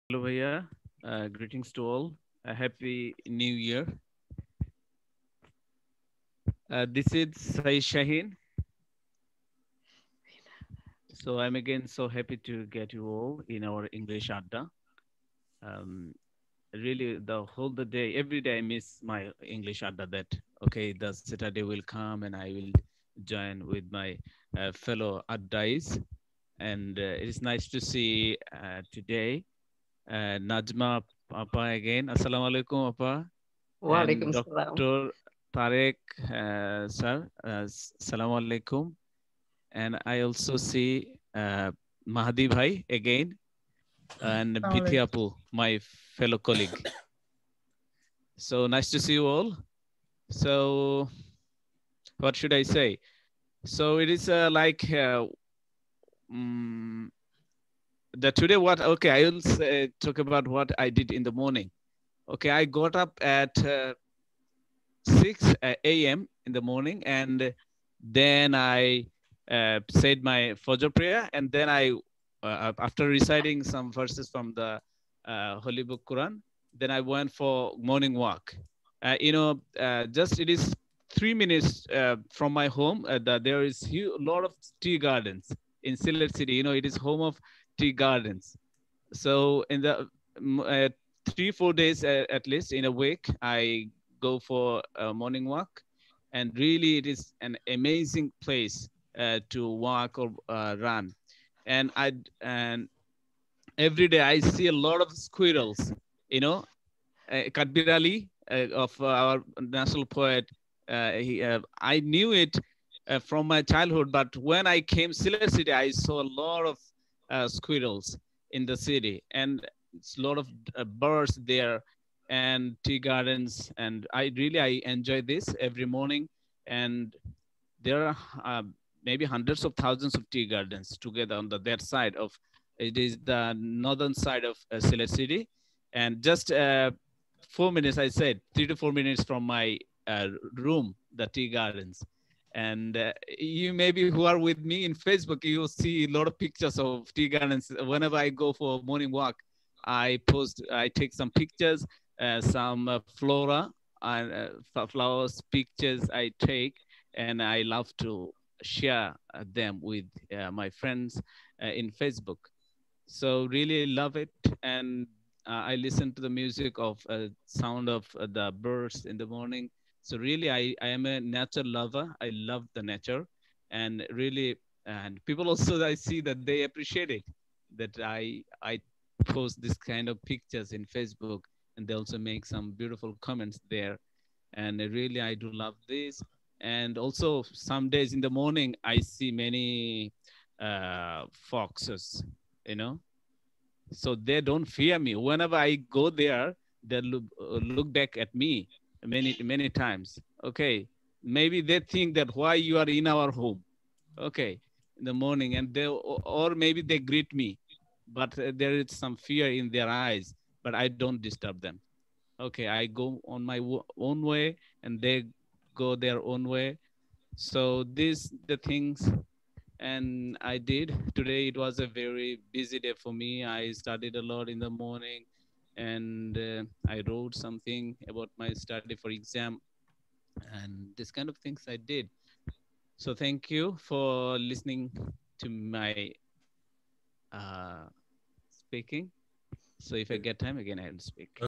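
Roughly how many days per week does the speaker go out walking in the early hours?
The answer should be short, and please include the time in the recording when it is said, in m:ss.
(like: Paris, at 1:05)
3 or 4, at 1:31.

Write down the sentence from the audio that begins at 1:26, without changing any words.
You know, it is home of tea gardens.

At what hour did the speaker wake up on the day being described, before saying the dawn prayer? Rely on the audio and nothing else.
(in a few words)
6 a.m.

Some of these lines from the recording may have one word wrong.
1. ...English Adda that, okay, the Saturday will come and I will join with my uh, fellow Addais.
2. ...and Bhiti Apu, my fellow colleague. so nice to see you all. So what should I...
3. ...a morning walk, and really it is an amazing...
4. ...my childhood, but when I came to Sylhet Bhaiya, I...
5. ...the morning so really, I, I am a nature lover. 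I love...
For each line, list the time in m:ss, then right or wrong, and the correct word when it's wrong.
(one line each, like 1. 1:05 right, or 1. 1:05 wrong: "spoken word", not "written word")
1. 0:19 right
2. 0:44 right
3. 1:34 right
4. 1:53 wrong: "City", not "Bhaiya"
5. 2:49 right.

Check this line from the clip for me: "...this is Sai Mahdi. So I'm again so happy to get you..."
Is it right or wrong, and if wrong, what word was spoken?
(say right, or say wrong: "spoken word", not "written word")
wrong: "Shaheen", not "Mahdi".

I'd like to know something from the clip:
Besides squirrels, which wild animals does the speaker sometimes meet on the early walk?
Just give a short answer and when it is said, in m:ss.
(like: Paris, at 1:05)
Foxes, at 3:11.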